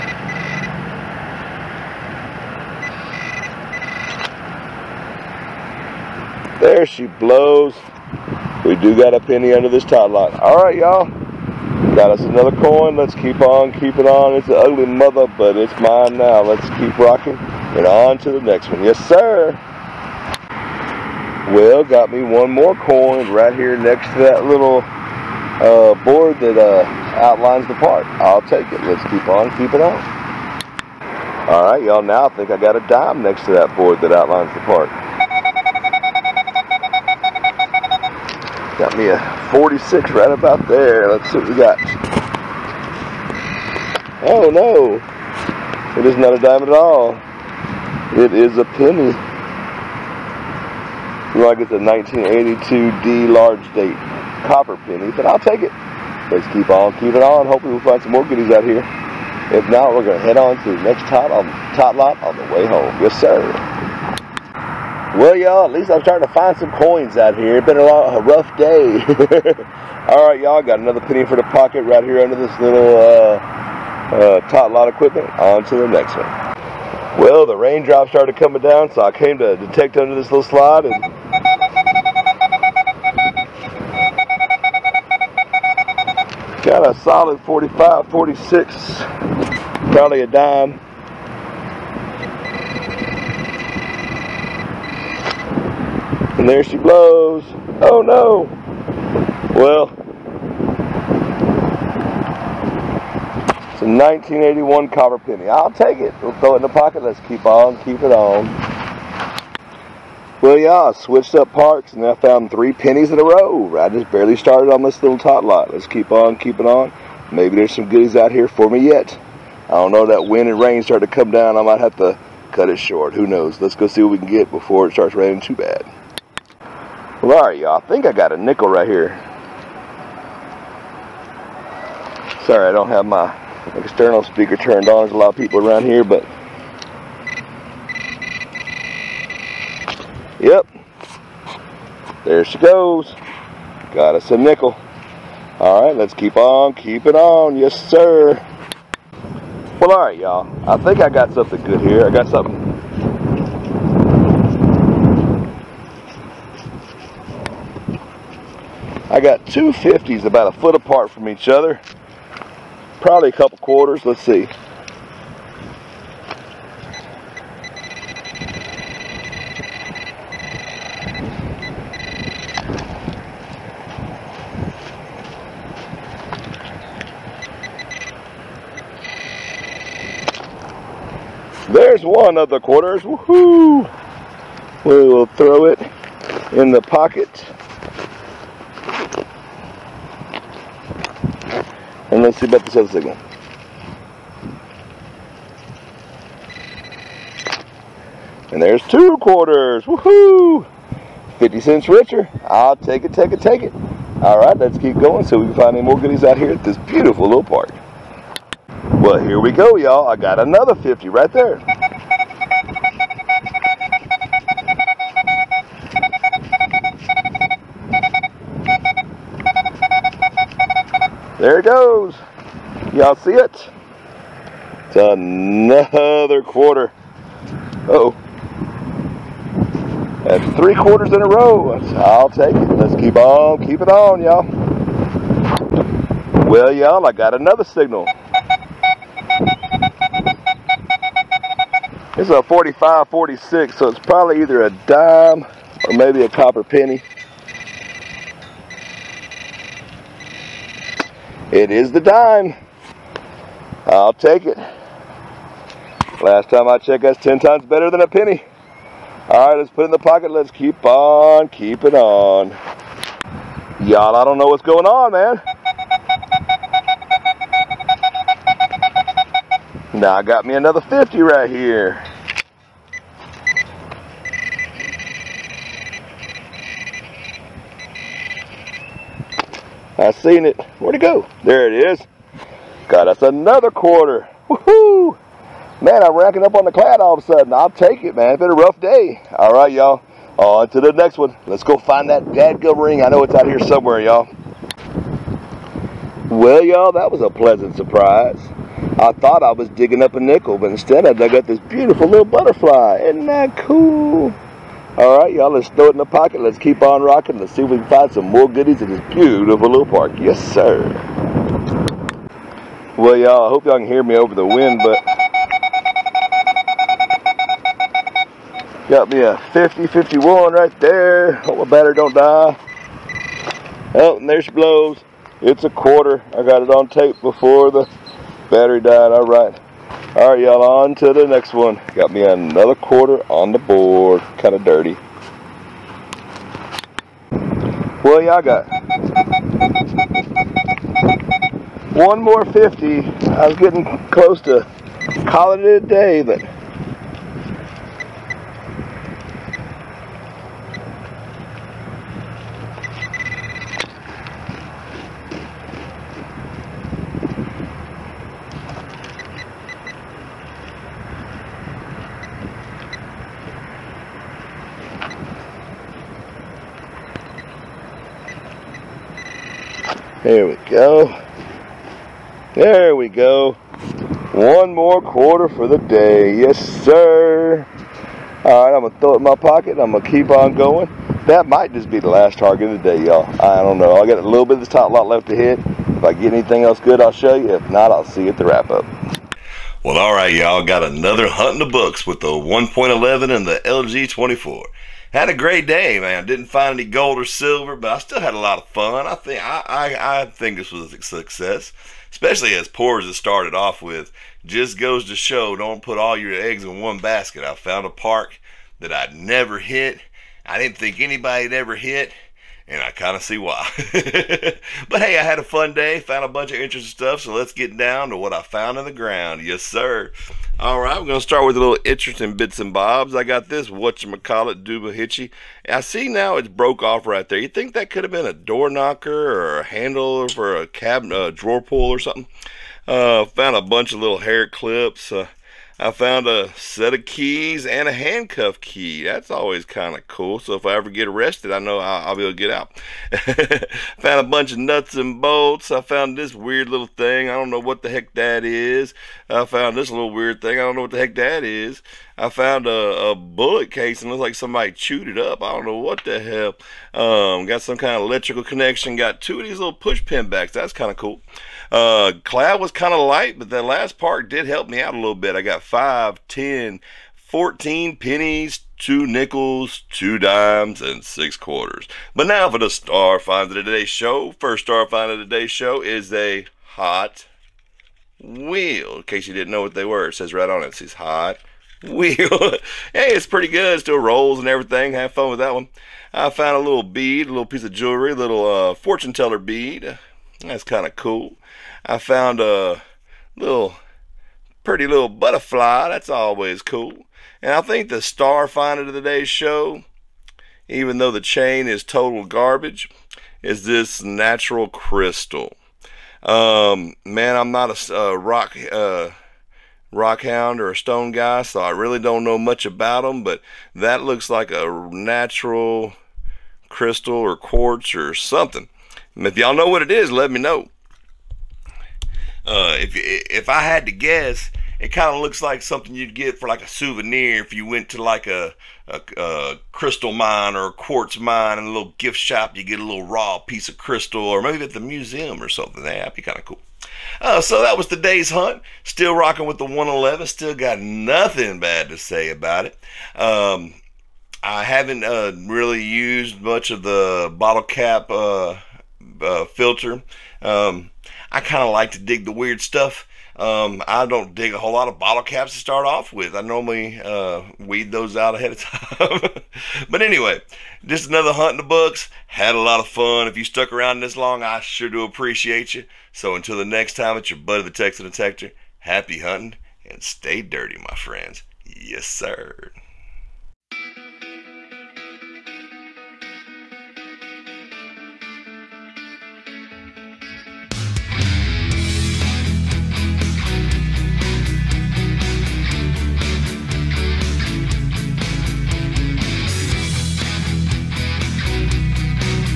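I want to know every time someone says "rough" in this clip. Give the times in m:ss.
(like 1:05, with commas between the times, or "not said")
1:08, 4:48.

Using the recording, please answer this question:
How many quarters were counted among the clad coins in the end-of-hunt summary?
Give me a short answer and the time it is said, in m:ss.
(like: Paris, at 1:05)
6, at 7:51.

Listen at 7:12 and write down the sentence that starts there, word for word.
Uh, found a bunch of little hair clips.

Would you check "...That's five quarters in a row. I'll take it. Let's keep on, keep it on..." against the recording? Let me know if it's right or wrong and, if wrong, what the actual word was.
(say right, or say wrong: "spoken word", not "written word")
wrong: "three", not "five".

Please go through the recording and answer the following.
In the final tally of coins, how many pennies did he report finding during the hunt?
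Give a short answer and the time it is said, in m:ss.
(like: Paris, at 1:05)
14, at 7:47.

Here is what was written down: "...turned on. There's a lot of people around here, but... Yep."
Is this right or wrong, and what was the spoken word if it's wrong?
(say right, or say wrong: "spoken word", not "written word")
right.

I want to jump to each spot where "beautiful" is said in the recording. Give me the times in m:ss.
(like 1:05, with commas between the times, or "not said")
3:26, 5:01, 5:09.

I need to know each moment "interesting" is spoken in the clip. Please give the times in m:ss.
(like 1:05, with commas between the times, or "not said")
6:56, 7:01.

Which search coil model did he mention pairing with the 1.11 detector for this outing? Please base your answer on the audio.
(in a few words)
LG 24.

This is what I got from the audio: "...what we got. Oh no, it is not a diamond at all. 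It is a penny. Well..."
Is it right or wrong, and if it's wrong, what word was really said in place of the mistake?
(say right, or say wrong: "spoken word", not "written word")
right.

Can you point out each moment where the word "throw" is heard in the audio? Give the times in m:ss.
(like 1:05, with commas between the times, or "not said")
1:46, 3:05, 5:05, 6:18.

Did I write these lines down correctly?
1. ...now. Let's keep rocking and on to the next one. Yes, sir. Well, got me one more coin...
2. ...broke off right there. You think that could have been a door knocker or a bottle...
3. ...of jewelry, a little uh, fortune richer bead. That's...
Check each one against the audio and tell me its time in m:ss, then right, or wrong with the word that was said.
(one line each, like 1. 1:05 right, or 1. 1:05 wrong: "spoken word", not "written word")
1. 0:16 right
2. 7:06 wrong: "handle", not "bottle"
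3. 8:07 wrong: "teller", not "richer".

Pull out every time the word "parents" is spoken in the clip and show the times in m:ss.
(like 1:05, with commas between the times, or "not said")
not said.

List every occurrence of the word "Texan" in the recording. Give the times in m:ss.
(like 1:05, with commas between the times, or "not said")
9:27.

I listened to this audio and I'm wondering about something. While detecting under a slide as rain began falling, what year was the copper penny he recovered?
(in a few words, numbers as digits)
1981.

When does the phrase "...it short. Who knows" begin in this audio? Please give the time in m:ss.
2:02.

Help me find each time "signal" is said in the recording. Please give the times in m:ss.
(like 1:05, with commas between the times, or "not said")
3:12, 3:57.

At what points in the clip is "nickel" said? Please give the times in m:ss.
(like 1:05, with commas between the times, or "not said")
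2:08, 2:24, 5:00, 7:49.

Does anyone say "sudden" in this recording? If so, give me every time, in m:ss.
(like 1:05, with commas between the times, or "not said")
4:47.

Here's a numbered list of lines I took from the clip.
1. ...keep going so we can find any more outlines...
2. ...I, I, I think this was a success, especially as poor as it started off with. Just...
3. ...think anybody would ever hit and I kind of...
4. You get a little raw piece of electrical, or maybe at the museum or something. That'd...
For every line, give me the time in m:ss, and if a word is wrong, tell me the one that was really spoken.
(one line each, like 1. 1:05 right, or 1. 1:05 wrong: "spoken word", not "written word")
1. 3:24 wrong: "goodies", not "outlines"
2. 6:39 right
3. 6:50 right
4. 8:52 wrong: "crystal", not "electrical".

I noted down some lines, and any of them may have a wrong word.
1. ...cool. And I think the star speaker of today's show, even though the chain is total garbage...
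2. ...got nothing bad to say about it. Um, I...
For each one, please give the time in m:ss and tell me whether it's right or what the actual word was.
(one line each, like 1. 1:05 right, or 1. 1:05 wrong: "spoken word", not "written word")
1. 8:16 wrong: "finder", not "speaker"
2. 9:00 right.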